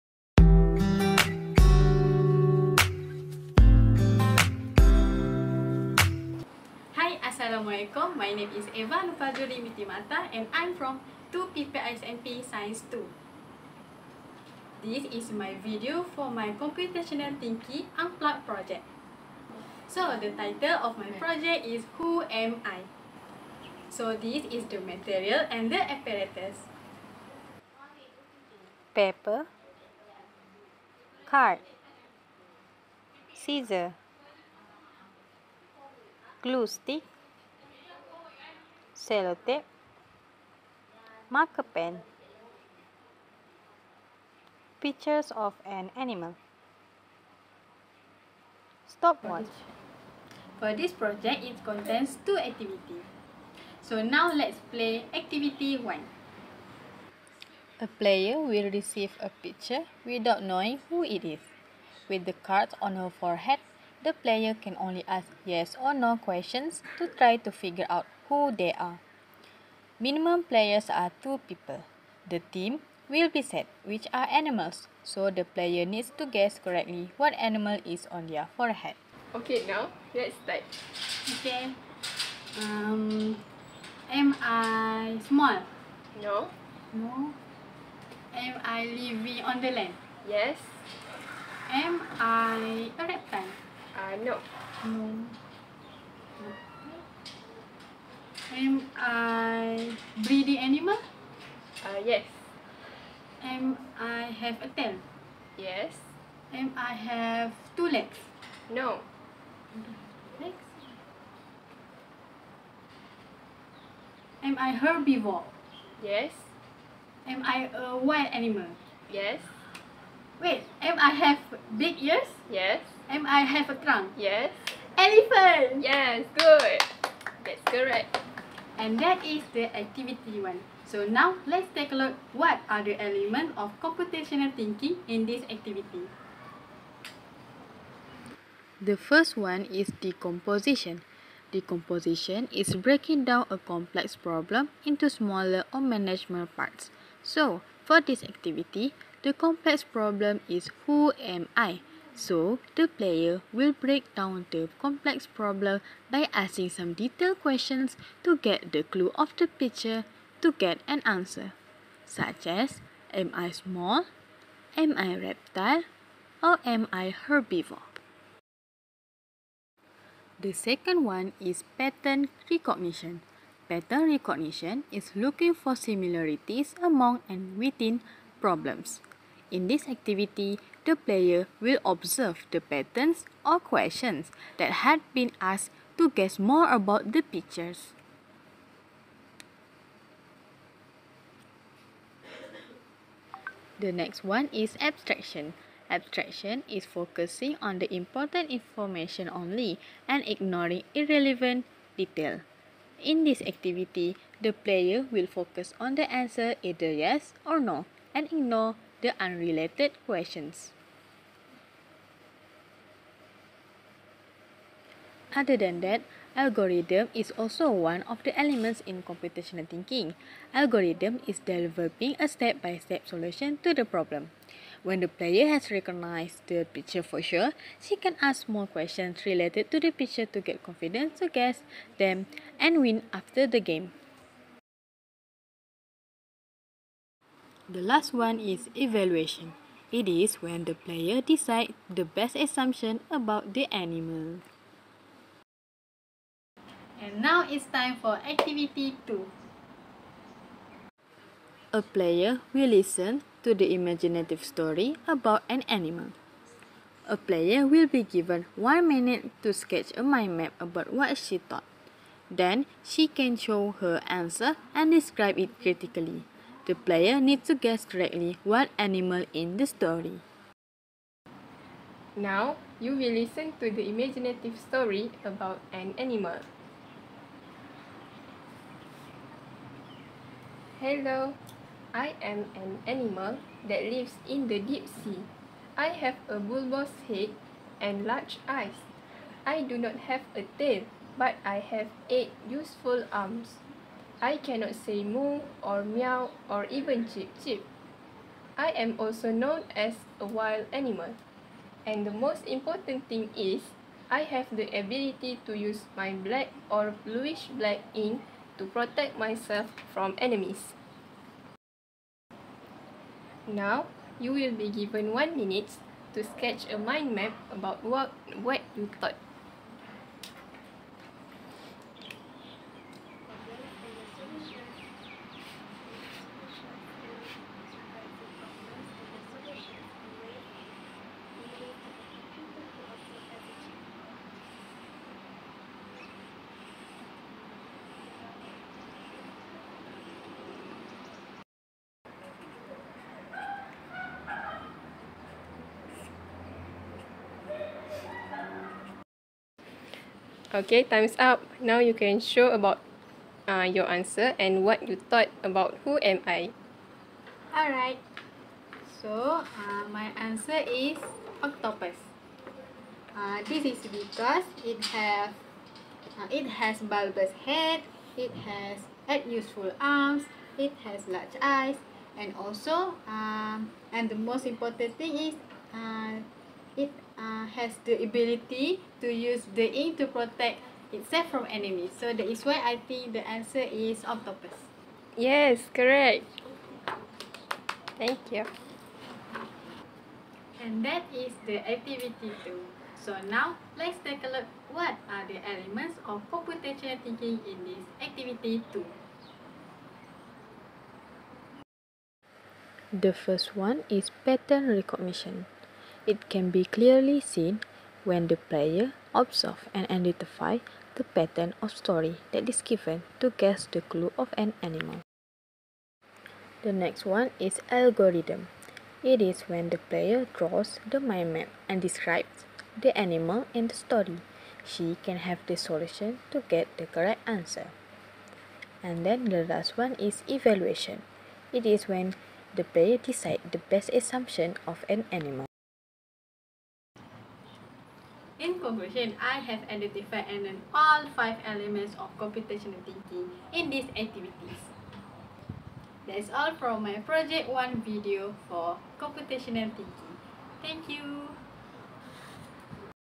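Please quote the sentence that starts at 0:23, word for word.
So, this is the material and the apparatus.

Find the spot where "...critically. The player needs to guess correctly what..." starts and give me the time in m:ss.
4:25.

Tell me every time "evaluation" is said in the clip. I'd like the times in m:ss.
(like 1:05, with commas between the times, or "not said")
3:58, 7:10.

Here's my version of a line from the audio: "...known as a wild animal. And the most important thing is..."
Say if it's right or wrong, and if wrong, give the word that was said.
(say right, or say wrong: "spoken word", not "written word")
right.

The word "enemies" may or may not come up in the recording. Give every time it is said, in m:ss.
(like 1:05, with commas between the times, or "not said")
5:10, 6:21.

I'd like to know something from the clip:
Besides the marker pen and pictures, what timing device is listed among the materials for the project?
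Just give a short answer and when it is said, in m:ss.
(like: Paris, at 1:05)
Stopwatch, at 0:48.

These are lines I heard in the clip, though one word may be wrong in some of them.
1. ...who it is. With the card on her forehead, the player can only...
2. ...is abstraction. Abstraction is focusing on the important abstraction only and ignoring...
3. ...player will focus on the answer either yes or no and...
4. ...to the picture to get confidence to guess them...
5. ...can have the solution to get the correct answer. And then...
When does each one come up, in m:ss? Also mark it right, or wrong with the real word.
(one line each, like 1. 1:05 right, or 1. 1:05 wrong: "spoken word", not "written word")
1. 1:00 right
2. 3:14 wrong: "information", not "abstraction"
3. 3:24 right
4. 3:49 right
5. 7:05 right.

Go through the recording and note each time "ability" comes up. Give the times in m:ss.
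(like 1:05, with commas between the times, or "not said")
5:04, 6:18.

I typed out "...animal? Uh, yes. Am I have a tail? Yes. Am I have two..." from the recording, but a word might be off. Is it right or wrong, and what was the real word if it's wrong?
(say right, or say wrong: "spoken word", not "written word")
right.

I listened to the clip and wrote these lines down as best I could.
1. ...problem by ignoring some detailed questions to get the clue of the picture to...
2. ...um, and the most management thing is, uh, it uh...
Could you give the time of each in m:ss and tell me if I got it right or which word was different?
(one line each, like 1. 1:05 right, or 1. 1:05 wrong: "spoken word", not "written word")
1. 2:35 wrong: "asking", not "ignoring"
2. 6:13 wrong: "important", not "management".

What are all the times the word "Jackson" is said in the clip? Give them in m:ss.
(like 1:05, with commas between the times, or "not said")
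not said.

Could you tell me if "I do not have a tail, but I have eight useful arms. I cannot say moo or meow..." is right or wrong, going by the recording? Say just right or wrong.
right.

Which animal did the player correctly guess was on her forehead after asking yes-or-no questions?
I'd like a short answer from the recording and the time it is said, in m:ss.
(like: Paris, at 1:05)
Elephant, at 2:04.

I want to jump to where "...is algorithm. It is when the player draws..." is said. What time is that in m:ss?
6:57.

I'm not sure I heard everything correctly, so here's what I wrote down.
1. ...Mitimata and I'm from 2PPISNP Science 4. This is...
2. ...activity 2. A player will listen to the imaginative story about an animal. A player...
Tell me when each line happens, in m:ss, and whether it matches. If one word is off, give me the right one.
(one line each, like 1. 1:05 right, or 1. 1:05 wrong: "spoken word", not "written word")
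1. 0:09 wrong: "2", not "4"
2. 4:08 right.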